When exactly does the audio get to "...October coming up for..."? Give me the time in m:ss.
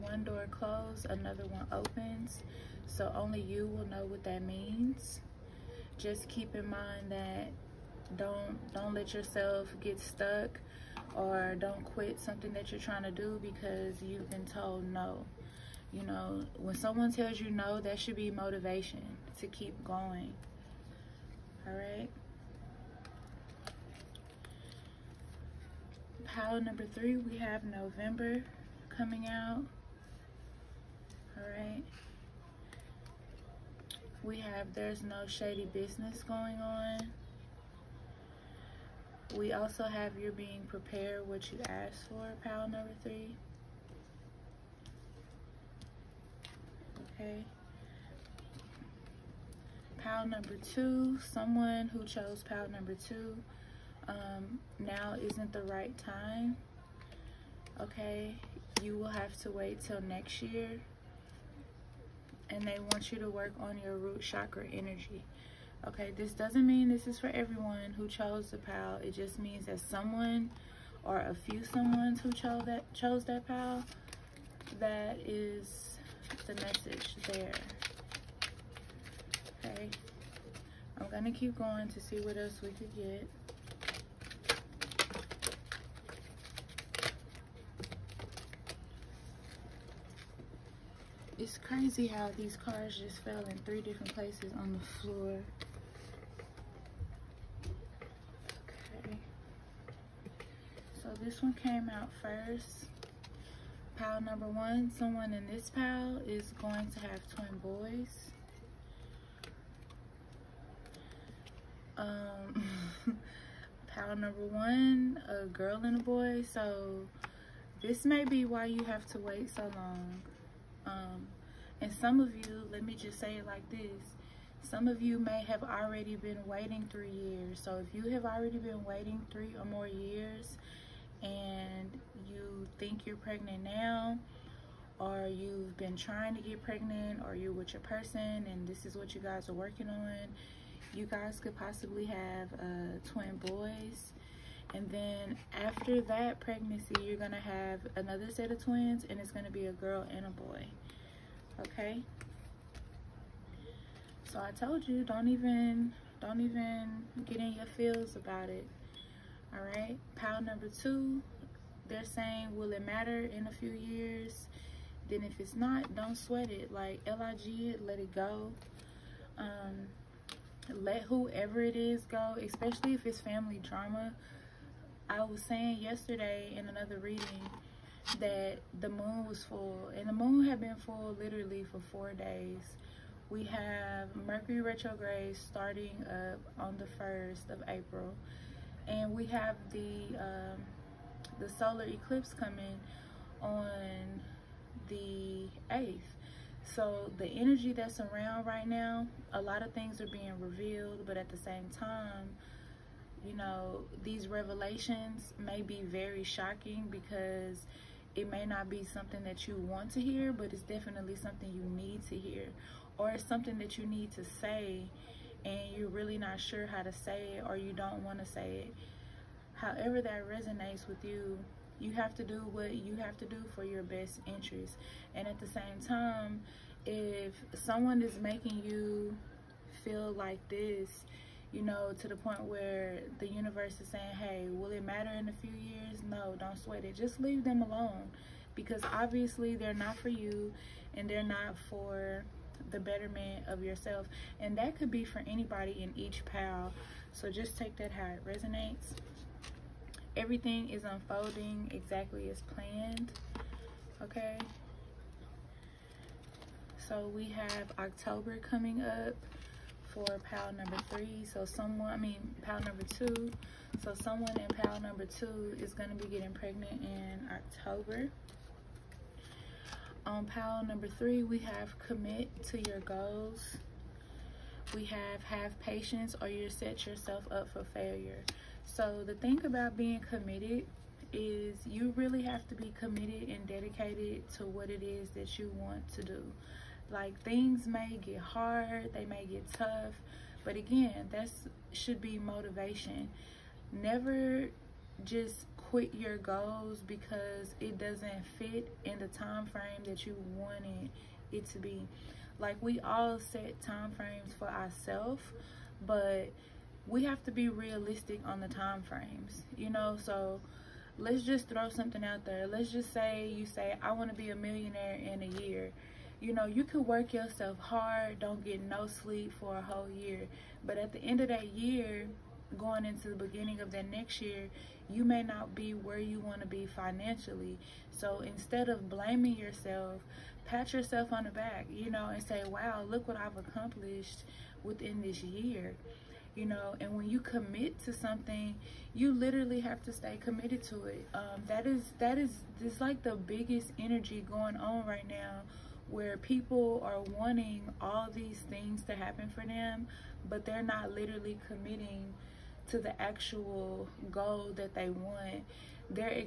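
4:17.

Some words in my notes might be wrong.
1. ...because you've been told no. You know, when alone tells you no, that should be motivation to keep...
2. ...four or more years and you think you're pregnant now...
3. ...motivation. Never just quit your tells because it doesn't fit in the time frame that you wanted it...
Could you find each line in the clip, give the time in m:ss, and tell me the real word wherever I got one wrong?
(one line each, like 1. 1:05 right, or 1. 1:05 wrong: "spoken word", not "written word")
1. 0:13 wrong: "someone", not "alone"
2. 2:09 wrong: "three", not "four"
3. 4:52 wrong: "goals", not "tells".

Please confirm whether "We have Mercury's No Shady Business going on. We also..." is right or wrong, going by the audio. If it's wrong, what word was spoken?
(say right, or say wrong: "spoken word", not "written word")
wrong: "There", not "Mercury".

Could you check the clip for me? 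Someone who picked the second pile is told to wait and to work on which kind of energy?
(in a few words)
Root chakra.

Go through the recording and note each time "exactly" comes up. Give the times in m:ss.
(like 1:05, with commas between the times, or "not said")
4:11.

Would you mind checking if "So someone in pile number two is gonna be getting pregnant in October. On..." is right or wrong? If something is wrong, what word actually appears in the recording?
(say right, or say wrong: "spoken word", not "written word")
right.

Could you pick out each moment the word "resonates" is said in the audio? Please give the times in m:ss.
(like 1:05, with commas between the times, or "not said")
3:40, 4:08.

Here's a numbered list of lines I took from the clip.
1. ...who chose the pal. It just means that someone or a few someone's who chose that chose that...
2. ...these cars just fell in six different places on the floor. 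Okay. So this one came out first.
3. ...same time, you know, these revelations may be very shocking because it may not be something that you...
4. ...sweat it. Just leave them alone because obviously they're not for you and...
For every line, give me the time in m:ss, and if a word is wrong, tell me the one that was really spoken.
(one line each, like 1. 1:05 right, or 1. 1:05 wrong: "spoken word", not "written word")
1. 1:07 right
2. 1:32 wrong: "three", not "six"
3. 3:21 right
4. 3:56 right.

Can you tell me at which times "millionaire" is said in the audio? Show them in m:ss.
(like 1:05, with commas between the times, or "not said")
5:14.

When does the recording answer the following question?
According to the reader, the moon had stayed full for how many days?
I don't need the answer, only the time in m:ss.
3:01.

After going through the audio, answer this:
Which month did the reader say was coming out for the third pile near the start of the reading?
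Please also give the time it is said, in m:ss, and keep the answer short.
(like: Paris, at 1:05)
November, at 0:27.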